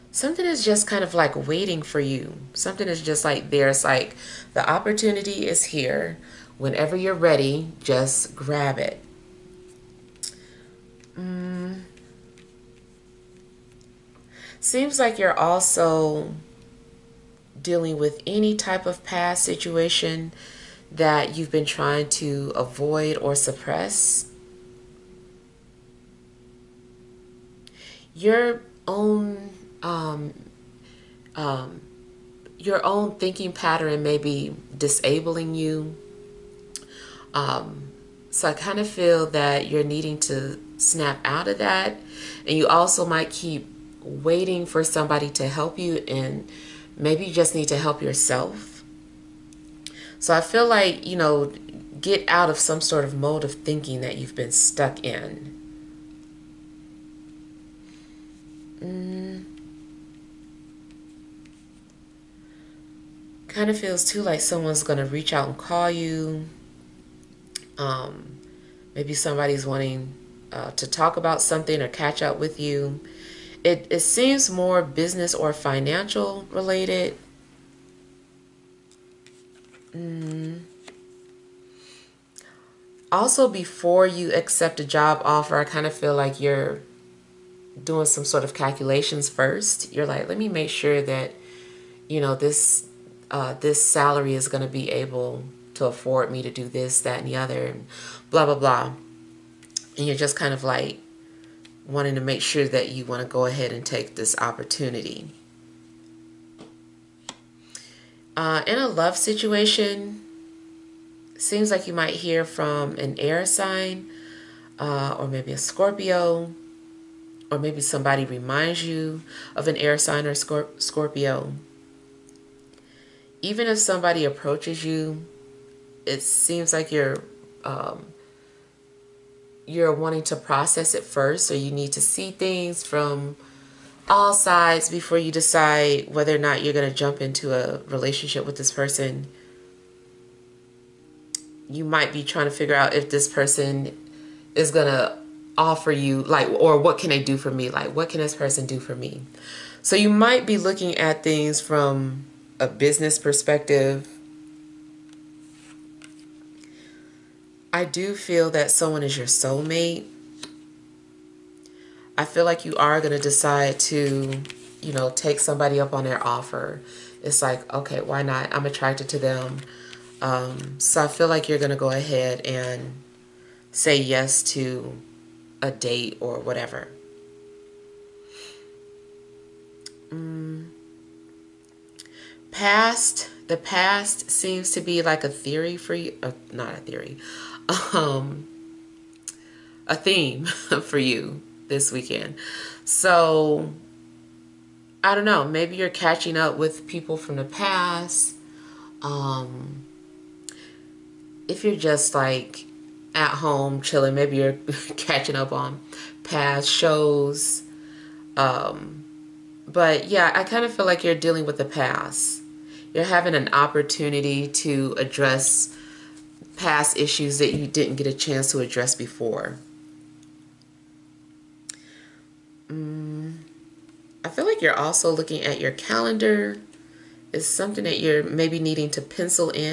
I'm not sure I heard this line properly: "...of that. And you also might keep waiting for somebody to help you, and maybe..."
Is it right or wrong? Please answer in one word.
right.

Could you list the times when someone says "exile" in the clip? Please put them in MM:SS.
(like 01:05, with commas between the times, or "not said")
not said.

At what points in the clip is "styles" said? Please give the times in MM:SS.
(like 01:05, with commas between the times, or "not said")
not said.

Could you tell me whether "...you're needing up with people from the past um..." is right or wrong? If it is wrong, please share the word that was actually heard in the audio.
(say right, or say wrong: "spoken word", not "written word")
wrong: "catching", not "needing".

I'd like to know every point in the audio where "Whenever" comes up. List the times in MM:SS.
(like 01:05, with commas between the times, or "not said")
00:06.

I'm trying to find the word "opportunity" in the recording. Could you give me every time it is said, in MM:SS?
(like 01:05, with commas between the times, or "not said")
00:04, 01:44, 03:33.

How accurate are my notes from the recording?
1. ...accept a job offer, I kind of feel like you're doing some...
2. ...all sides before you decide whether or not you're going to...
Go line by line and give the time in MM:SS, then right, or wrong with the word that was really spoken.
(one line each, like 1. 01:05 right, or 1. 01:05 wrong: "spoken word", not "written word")
1. 01:24 right
2. 02:14 right.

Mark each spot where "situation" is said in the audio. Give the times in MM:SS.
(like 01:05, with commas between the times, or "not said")
00:19, 01:49.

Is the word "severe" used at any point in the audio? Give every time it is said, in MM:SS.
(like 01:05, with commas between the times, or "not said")
not said.